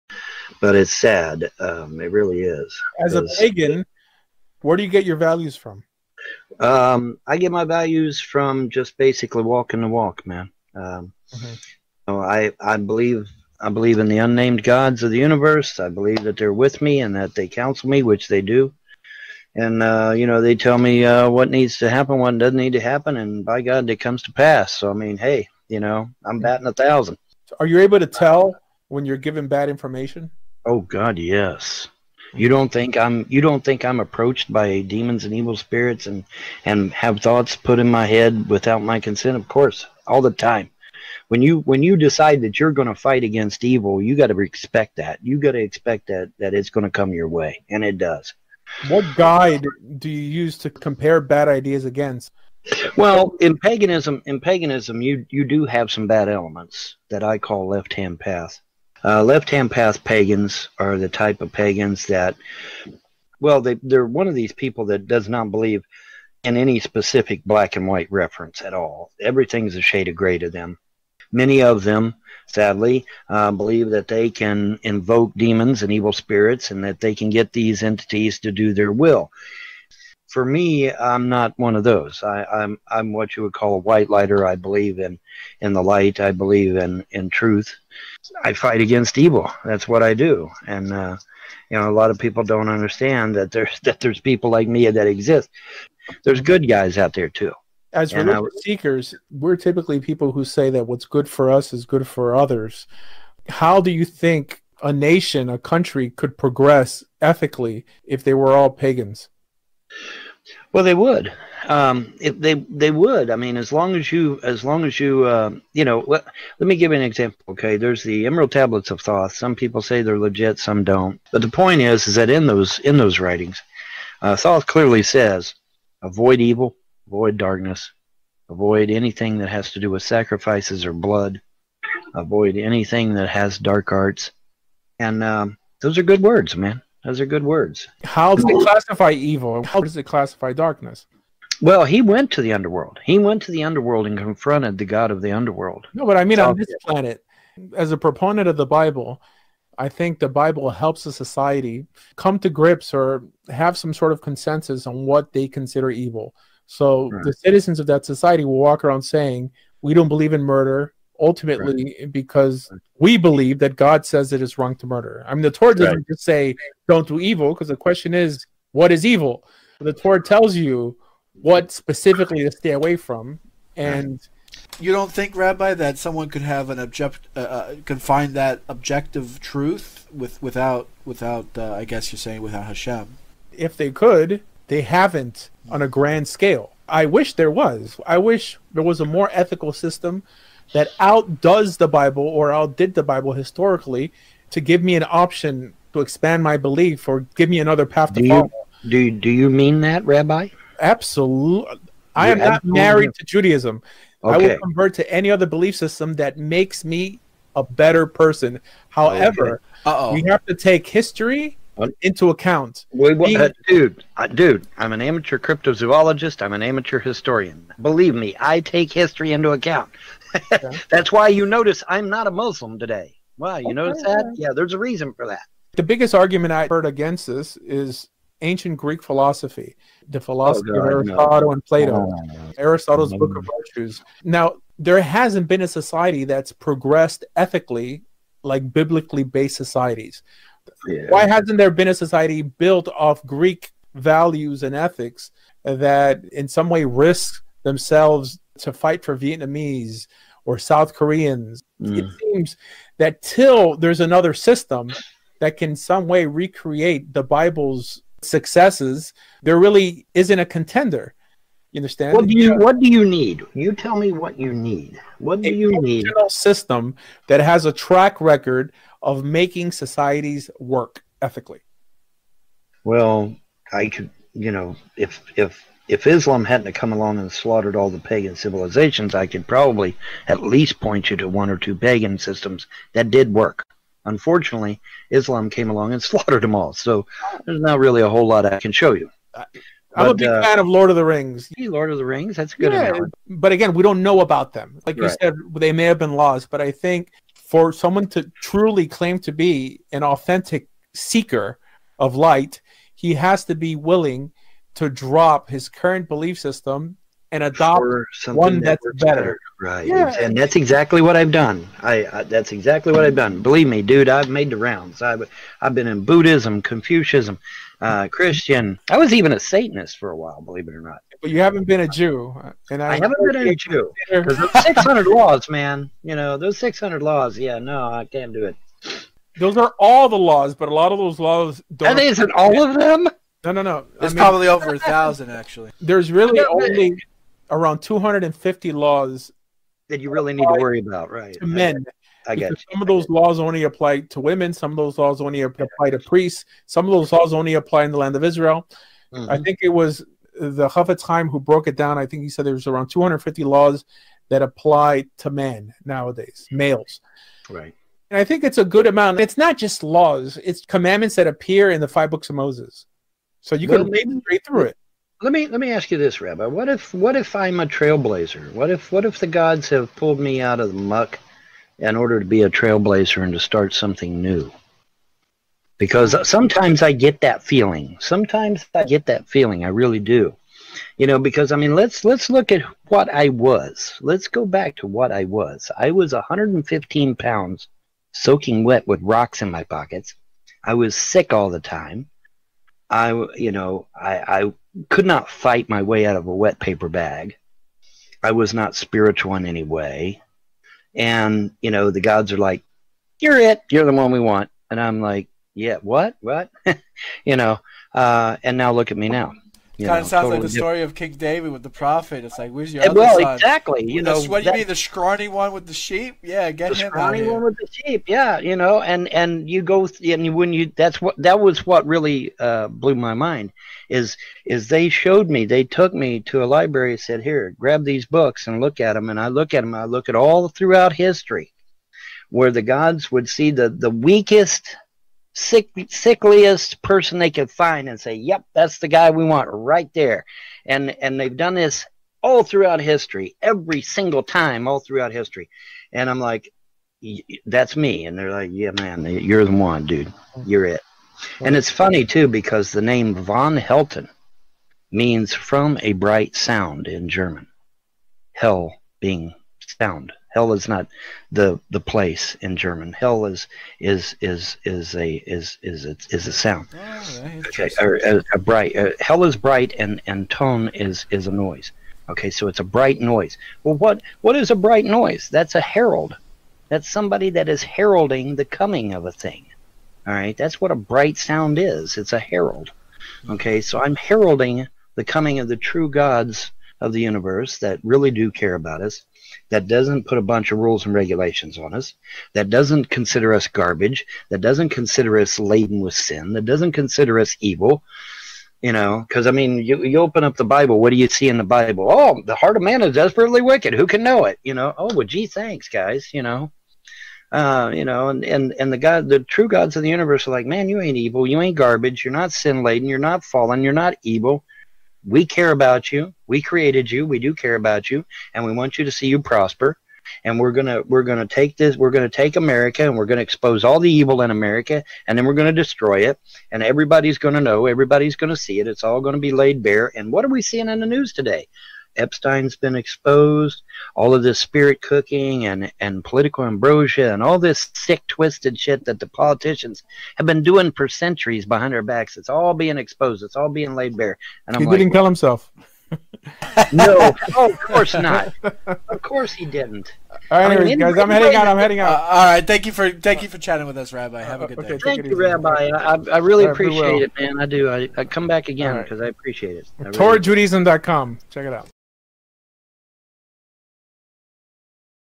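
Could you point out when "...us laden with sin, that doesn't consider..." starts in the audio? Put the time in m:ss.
8:15.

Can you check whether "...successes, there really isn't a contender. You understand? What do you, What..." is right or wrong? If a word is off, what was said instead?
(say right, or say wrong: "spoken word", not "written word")
right.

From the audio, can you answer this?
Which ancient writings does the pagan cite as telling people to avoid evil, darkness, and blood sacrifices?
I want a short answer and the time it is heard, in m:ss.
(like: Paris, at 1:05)
Emerald Tablets of Thoth, at 1:58.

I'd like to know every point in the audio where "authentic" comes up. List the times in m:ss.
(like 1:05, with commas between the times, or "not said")
5:00.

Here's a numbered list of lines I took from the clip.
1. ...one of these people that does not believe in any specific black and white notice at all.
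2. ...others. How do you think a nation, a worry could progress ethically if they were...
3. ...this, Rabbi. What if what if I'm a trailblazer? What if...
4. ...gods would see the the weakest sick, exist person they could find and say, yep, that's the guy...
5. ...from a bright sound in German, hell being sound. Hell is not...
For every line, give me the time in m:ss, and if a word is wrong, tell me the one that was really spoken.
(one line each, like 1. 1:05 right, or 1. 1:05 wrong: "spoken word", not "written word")
1. 1:04 wrong: "reference", not "notice"
2. 1:42 wrong: "country", not "worry"
3. 6:05 right
4. 7:12 wrong: "sickliest", not "exist"
5. 7:35 right.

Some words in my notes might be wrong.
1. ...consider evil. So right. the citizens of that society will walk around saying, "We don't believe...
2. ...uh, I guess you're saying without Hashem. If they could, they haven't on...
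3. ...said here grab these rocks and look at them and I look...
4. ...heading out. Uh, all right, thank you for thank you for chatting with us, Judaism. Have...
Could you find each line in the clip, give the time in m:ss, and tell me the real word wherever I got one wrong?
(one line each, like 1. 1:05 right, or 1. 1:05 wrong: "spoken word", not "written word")
1. 2:35 right
2. 3:01 right
3. 7:06 wrong: "books", not "rocks"
4. 9:11 wrong: "Rabbi", not "Judaism".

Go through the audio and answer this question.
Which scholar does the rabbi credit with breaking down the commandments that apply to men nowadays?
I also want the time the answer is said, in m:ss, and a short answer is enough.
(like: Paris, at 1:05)
Chofetz Chaim, at 5:50.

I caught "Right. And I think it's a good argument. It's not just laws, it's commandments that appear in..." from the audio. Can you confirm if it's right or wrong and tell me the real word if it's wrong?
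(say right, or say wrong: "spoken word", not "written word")
wrong: "amount", not "argument".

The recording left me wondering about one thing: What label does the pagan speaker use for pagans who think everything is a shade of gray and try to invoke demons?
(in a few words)
left-hand path.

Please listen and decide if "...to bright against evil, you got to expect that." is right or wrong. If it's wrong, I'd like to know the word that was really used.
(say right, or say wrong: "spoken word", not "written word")
wrong: "fight", not "bright".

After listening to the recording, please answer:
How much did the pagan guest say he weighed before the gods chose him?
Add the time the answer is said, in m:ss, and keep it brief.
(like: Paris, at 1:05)
115 pounds, at 6:26.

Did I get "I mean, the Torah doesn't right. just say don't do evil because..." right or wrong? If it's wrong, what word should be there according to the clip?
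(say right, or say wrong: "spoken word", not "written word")
right.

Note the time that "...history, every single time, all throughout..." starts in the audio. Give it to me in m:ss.
7:22.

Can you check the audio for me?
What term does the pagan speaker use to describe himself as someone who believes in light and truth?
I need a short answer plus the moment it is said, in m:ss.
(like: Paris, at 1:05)
white lighter, at 1:23.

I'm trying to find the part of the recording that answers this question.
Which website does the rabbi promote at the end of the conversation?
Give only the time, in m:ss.
9:19.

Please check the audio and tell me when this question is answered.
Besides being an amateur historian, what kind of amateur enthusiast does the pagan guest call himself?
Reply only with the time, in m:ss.
3:35.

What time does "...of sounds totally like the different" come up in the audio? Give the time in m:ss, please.
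6:50.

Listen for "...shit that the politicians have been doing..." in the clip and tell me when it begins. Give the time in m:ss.
8:58.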